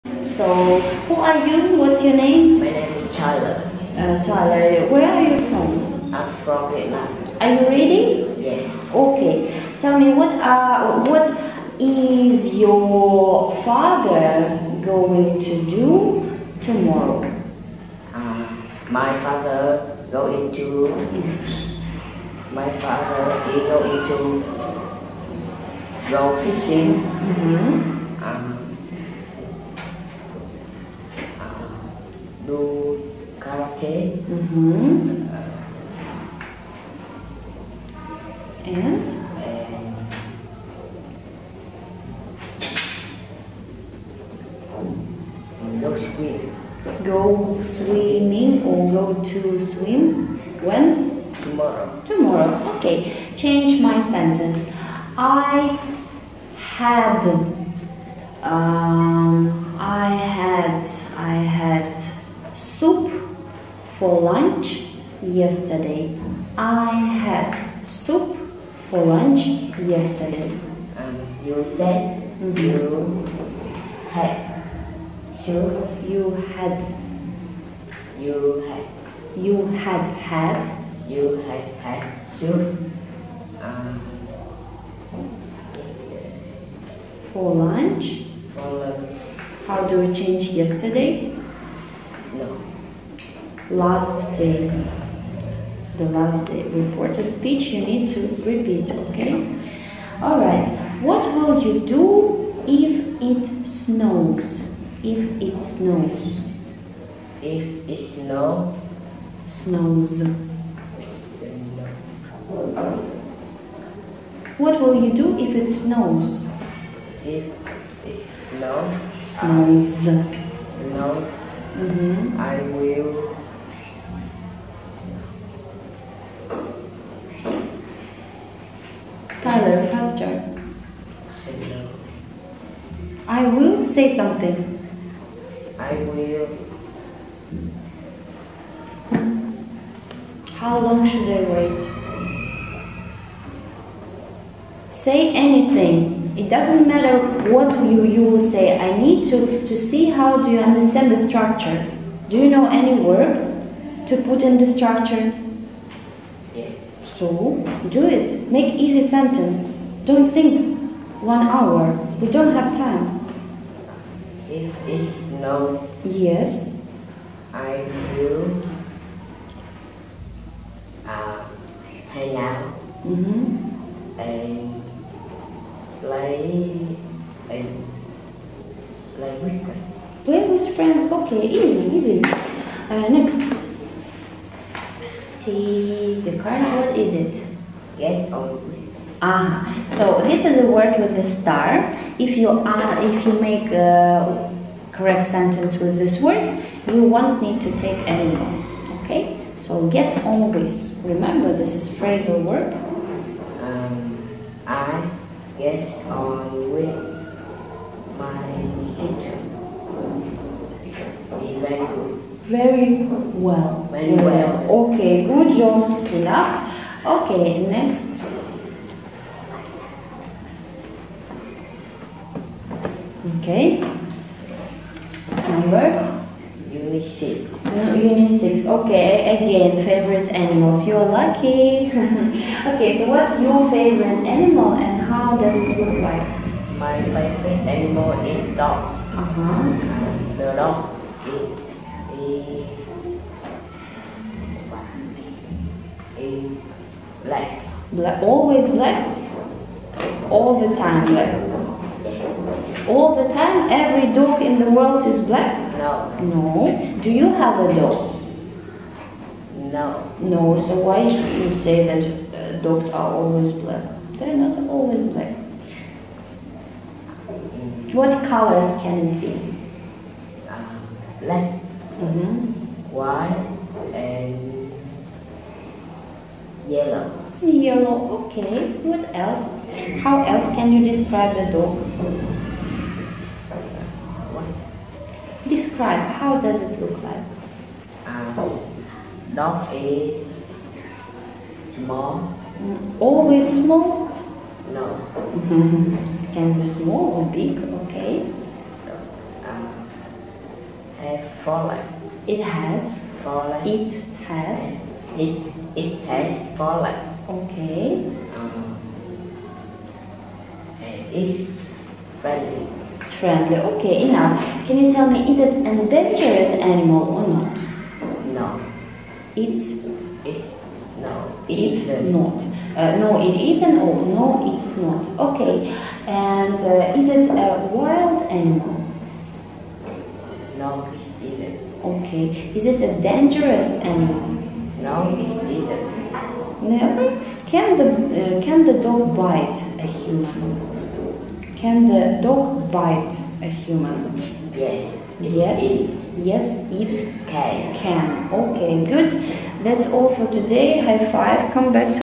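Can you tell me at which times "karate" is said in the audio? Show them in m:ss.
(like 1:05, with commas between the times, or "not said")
0:33.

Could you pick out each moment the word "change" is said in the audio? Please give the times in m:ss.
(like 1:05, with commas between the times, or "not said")
0:53, 1:30.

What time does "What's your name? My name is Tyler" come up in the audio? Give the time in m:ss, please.
0:01.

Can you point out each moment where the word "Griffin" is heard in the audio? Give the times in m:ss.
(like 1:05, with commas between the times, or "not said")
not said.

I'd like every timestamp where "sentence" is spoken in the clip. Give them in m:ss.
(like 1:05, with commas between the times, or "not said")
0:54, 2:39, 3:15.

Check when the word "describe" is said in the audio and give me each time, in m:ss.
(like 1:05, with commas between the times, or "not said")
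4:40, 4:45.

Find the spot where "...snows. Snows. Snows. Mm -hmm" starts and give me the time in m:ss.
1:58.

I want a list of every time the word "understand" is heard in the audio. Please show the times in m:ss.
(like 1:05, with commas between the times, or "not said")
2:30.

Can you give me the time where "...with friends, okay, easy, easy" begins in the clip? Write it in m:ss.
3:00.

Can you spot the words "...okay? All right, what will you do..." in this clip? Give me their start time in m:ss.
1:39.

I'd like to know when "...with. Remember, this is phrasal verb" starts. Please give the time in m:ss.
3:20.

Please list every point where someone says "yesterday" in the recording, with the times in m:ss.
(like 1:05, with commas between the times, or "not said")
1:05, 1:09, 1:30.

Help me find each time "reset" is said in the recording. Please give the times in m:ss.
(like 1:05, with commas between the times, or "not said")
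not said.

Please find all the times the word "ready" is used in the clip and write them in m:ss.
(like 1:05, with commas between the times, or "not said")
0:07.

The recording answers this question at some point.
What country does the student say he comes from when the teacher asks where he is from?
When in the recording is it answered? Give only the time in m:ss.
0:06.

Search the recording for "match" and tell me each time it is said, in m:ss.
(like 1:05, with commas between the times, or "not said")
not said.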